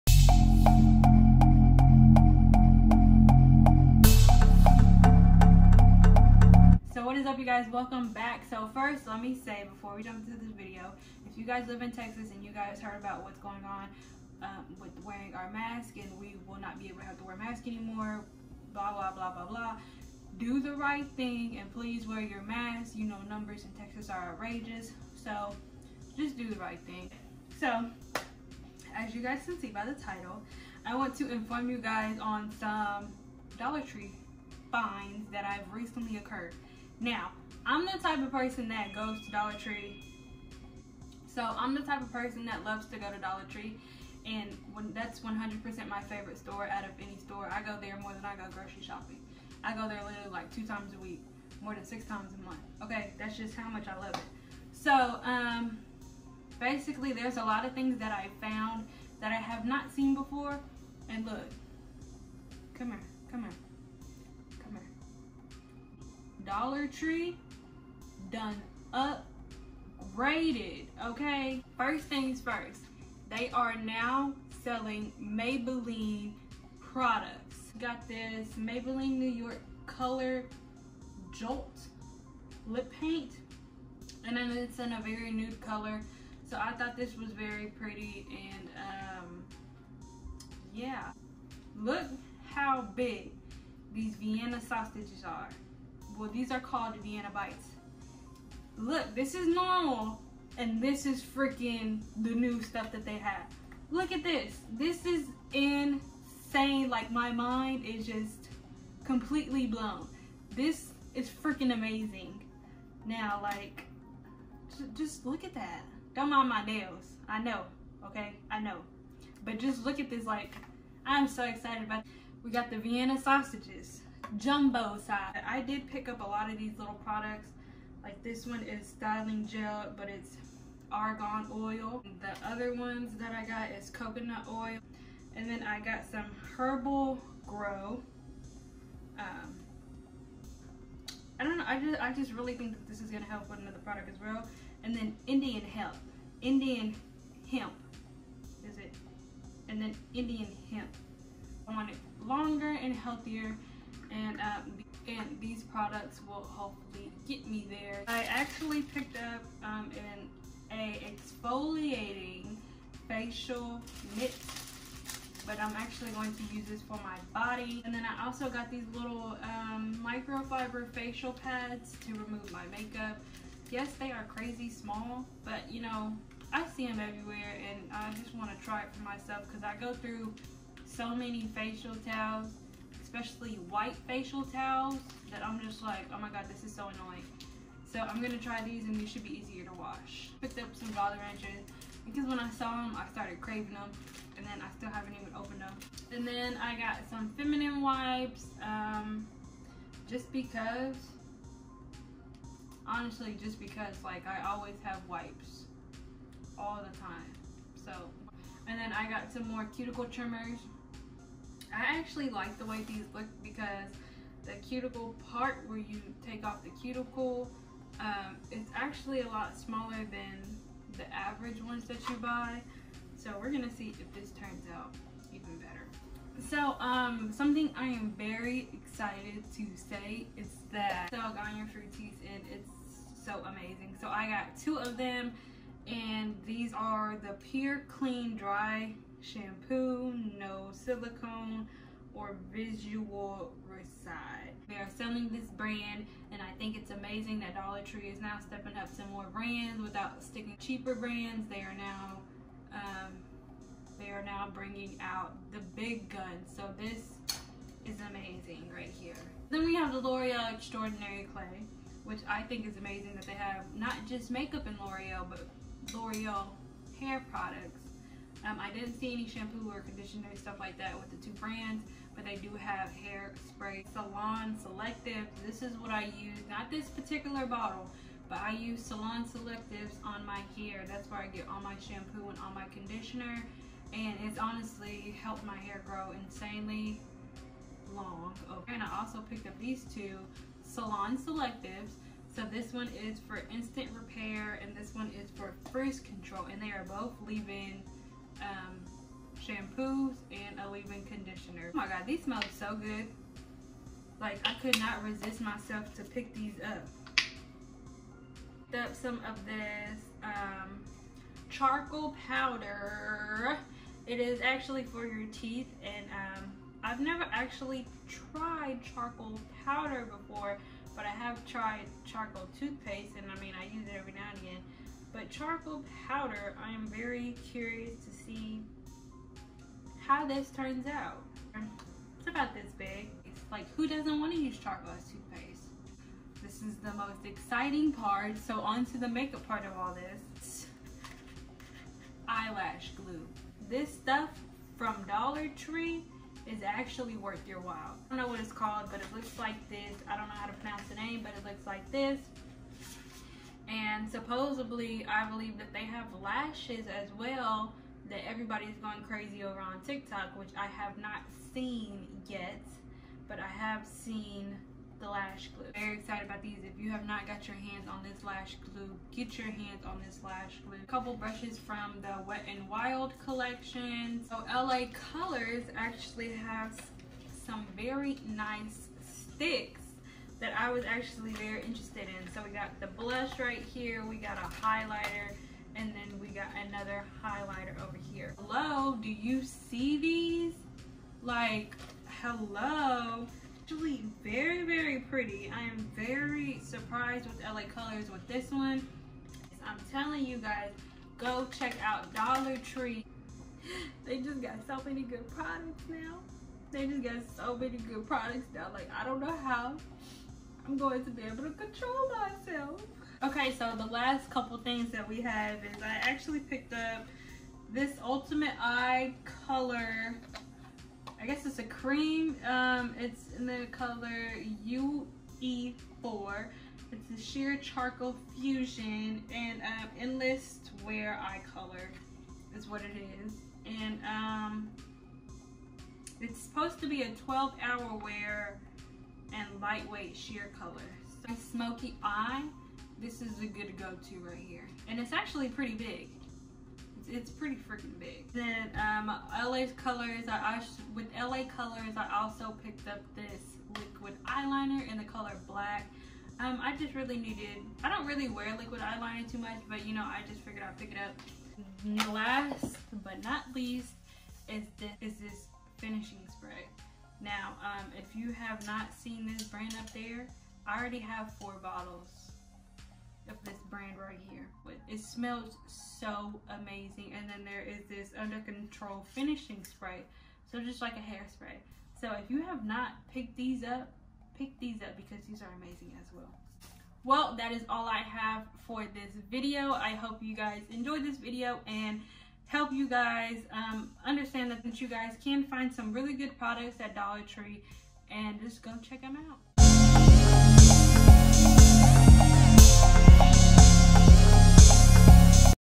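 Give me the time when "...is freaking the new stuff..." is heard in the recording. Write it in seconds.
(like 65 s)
101 s.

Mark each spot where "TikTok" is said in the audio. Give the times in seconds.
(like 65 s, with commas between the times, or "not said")
359 s.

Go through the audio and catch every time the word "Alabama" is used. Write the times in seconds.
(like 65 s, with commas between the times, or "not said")
not said.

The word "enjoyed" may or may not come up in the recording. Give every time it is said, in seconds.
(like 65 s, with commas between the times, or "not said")
490 s.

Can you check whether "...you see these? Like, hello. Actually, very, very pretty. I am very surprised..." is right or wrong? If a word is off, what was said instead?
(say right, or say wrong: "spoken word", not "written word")
right.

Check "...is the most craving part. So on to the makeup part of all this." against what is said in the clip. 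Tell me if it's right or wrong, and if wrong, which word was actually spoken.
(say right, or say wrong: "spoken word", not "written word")
wrong: "exciting", not "craving".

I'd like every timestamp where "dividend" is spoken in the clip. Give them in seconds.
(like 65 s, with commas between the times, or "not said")
not said.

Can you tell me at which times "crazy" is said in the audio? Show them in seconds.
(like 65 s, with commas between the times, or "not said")
174 s, 359 s.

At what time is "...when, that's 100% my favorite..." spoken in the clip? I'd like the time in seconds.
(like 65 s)
44 s.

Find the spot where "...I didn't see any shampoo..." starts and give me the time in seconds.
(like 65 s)
268 s.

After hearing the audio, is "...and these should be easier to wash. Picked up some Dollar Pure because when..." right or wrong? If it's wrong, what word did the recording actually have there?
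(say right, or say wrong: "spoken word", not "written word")
wrong: "Ranchers", not "Pure".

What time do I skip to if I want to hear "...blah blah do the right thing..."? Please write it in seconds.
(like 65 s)
19 s.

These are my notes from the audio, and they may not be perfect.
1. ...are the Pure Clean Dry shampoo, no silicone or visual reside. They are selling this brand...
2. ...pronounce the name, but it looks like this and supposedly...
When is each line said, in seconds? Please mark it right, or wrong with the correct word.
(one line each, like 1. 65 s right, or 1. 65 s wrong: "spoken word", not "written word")
1. 236 s right
2. 350 s right.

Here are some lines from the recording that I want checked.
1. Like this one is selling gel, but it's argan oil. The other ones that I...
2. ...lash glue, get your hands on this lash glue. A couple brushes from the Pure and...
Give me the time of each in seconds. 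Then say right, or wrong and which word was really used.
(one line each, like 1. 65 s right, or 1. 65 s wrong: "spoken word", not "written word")
1. 128 s wrong: "styling", not "selling"
2. 368 s wrong: "Wet", not "Pure".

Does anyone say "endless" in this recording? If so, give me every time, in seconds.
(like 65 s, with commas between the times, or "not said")
429 s.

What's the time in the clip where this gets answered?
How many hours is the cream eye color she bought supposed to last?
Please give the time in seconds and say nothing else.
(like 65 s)
437 s.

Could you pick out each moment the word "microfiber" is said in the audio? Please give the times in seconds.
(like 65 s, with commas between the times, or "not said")
170 s.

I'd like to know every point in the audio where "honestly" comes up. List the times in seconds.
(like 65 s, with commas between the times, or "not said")
202 s, 284 s.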